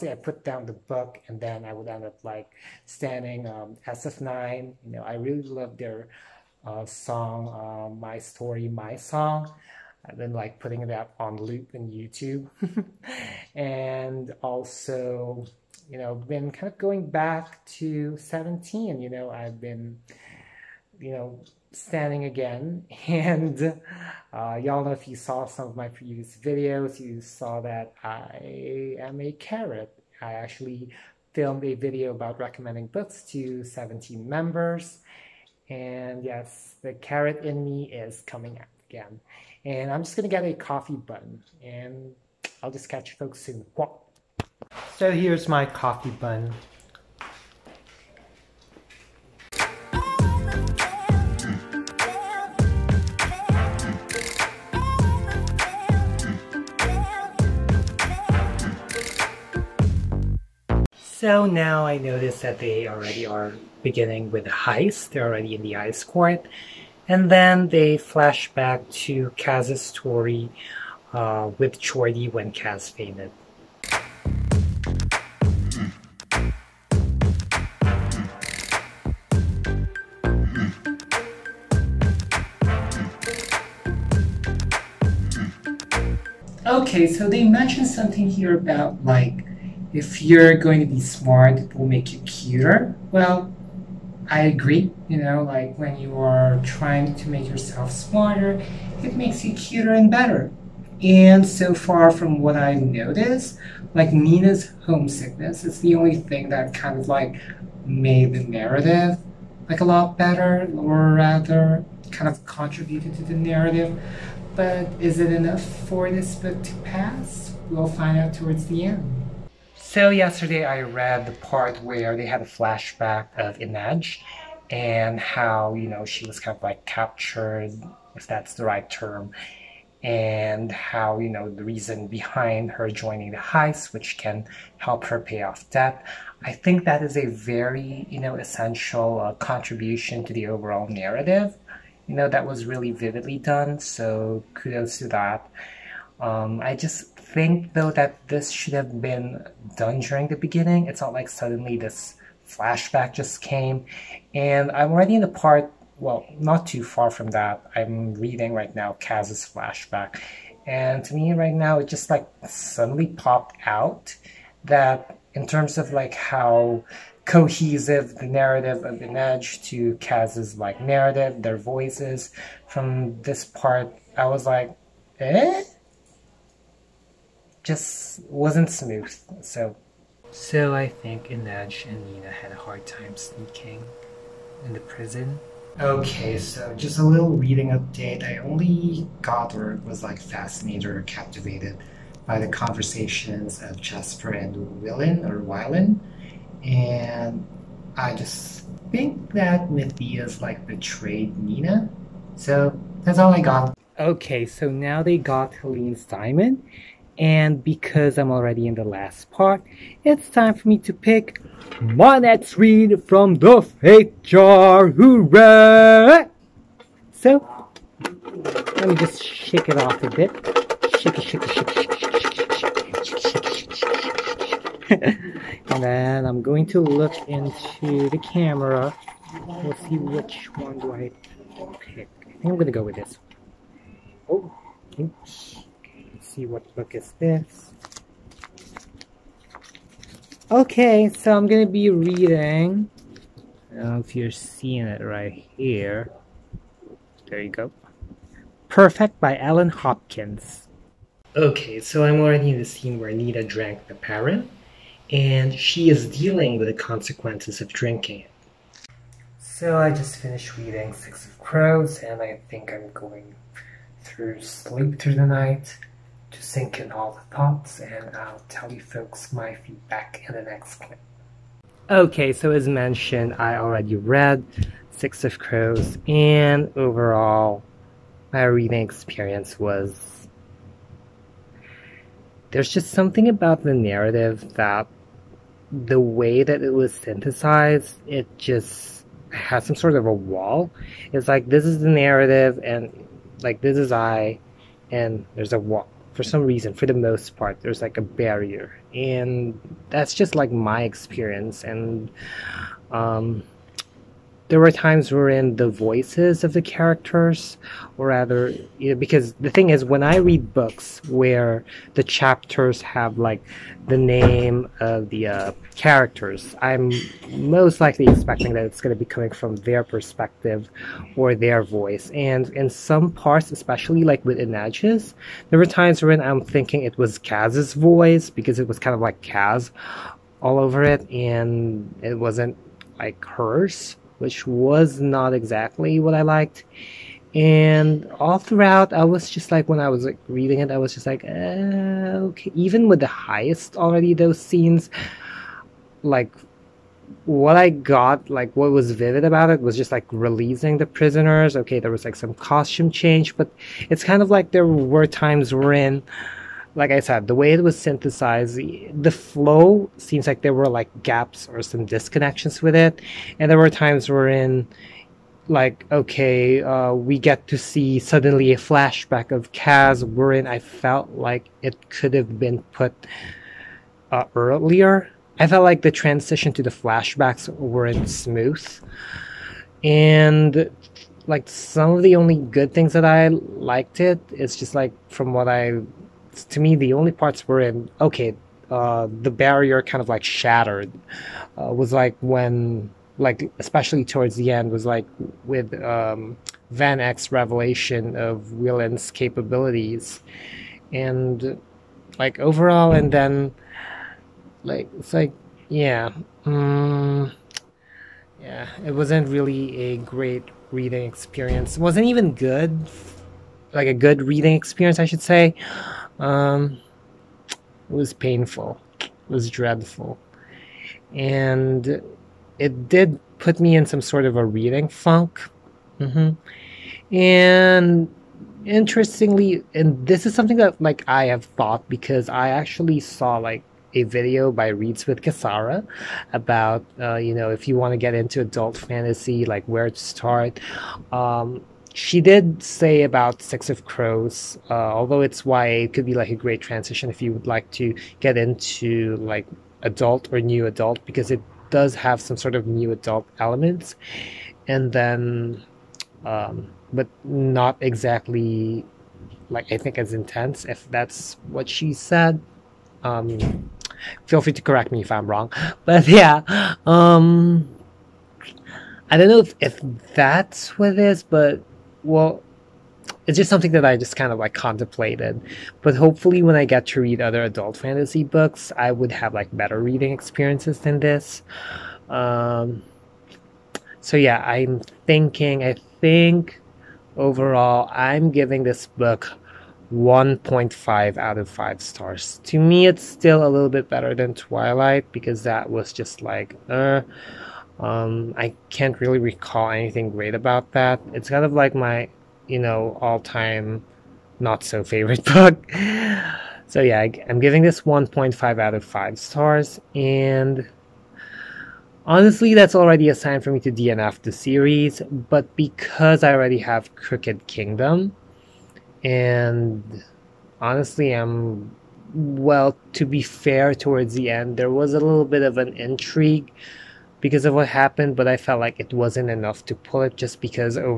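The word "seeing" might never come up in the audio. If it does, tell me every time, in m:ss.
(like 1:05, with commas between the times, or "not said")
4:04.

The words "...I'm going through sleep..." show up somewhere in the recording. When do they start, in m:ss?
4:22.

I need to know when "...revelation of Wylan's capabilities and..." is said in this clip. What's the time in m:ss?
6:37.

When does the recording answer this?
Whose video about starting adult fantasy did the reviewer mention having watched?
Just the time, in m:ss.
7:14.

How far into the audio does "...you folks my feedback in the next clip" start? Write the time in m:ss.
4:28.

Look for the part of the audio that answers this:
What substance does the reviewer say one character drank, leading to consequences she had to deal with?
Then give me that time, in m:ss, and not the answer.
4:13.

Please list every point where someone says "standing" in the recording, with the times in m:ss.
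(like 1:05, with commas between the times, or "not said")
0:02, 0:21.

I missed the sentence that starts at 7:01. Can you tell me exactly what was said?
And it did put me in some sort of a reading funk.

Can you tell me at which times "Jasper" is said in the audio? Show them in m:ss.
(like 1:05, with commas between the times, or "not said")
3:13.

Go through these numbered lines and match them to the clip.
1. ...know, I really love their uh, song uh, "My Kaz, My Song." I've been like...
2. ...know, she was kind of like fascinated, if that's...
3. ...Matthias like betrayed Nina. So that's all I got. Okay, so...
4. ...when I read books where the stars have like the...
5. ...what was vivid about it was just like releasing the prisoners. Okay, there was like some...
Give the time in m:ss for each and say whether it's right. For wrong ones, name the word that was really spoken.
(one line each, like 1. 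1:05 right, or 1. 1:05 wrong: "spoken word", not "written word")
1. 0:04 wrong: "Story", not "Kaz"
2. 2:05 wrong: "captured", not "fascinated"
3. 3:19 right
4. 5:09 wrong: "chapters", not "stars"
5. 5:48 right.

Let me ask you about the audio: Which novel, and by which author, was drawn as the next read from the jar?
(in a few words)
Perfect by Ellen Hopkins.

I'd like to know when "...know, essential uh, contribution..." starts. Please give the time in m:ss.
2:18.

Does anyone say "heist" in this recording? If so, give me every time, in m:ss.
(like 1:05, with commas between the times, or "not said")
1:04, 2:13.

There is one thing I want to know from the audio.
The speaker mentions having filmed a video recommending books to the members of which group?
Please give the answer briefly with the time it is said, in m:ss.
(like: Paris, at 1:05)
17, at 0:33.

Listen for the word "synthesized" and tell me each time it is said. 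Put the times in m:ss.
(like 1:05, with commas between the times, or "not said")
4:46, 5:57.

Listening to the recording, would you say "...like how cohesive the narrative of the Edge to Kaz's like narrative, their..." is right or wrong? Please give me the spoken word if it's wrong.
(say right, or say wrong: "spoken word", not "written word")
right.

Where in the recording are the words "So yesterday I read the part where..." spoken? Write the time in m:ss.
1:59.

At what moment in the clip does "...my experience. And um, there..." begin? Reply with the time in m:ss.
5:00.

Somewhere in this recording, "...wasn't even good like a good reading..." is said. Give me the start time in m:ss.
6:51.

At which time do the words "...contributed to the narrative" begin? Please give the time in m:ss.
1:52.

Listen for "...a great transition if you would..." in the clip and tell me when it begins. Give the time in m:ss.
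7:26.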